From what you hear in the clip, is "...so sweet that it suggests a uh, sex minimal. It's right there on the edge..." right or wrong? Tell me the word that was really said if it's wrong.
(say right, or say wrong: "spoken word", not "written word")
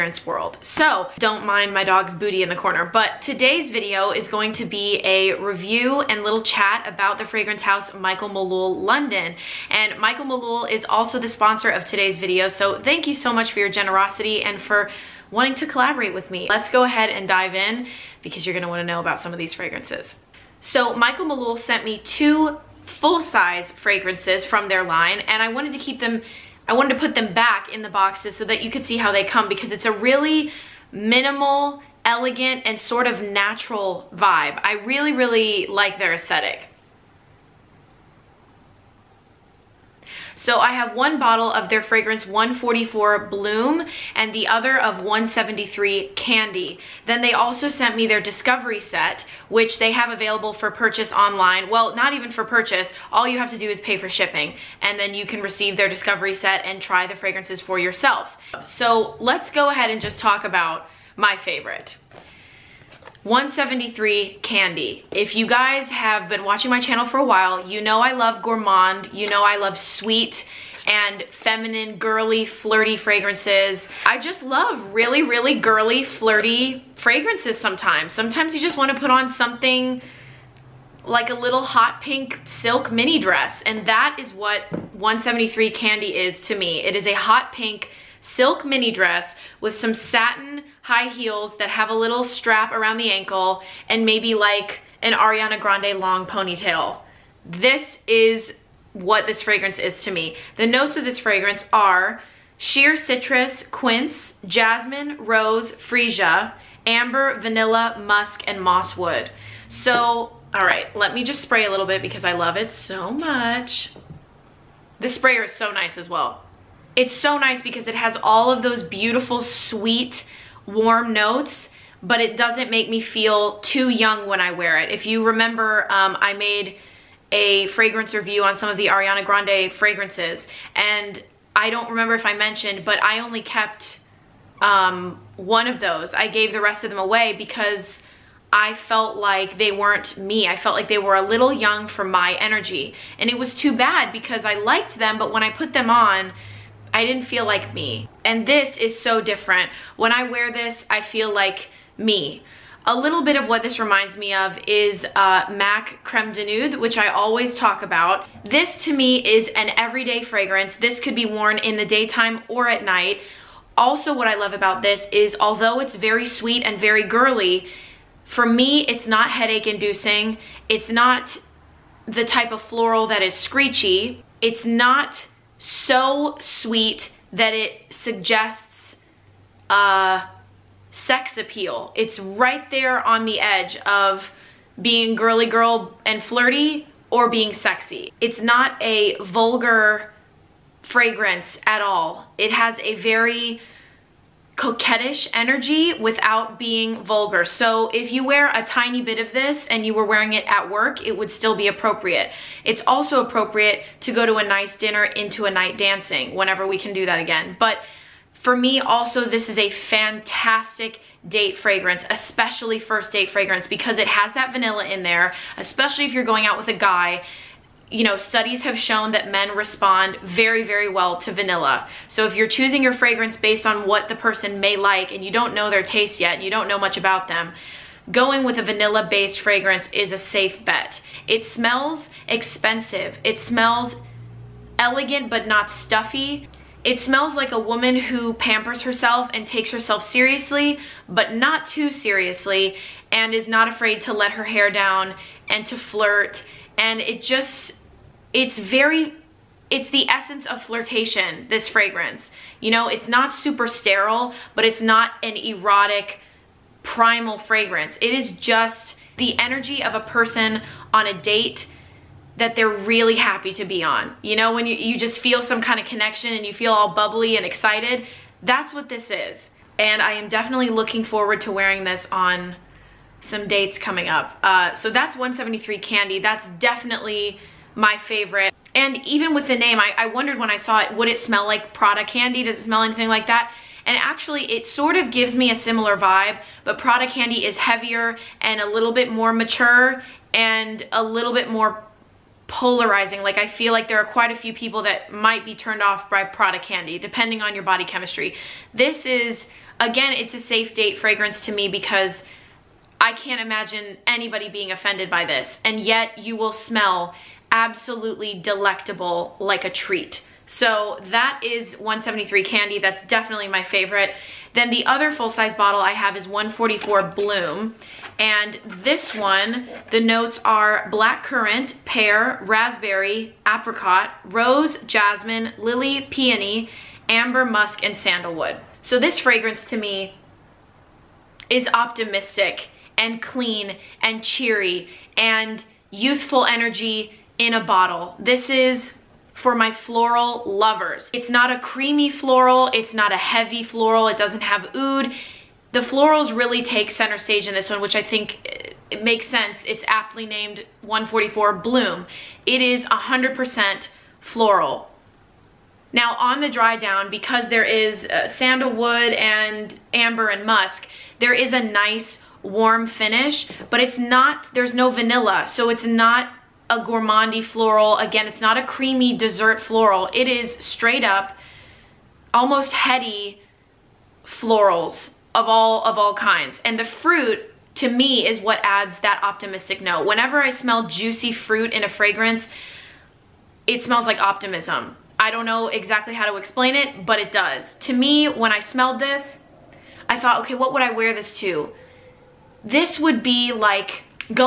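wrong: "appeal", not "minimal".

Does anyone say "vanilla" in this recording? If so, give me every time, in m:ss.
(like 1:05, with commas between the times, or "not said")
1:47, 3:34, 3:41, 3:48, 6:04.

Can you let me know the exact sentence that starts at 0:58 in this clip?
So let's go ahead and just talk about my favorite.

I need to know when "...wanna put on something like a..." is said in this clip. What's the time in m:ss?
1:18.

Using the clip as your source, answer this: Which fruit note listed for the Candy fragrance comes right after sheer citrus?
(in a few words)
Quince.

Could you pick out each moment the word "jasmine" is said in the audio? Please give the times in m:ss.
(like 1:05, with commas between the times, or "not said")
1:44, 5:24.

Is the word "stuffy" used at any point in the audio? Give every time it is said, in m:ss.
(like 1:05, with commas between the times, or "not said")
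3:55.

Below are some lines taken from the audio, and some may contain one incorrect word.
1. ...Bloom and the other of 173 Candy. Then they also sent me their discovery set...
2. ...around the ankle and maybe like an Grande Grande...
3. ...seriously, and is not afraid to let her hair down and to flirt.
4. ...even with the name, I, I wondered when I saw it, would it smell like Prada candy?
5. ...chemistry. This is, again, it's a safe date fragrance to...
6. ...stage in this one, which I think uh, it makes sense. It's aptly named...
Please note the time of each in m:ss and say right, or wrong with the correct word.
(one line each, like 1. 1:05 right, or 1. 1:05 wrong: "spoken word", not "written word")
1. 0:43 right
2. 1:32 wrong: "Ariana", not "Grande"
3. 4:01 right
4. 4:39 right
5. 4:57 right
6. 5:47 right.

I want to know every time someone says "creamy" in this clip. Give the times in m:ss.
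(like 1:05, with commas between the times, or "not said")
5:41, 6:08.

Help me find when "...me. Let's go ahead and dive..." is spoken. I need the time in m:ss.
0:16.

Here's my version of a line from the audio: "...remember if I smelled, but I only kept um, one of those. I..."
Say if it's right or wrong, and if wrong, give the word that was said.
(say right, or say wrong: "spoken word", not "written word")
wrong: "mentioned", not "smelled".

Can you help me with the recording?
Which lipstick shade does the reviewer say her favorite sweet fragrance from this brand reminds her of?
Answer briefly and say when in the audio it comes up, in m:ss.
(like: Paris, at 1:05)
MAC Creme de Nude, at 2:35.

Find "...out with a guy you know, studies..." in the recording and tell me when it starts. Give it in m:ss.
3:36.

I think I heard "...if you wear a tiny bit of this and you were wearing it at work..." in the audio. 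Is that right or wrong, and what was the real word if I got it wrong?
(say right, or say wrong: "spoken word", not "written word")
right.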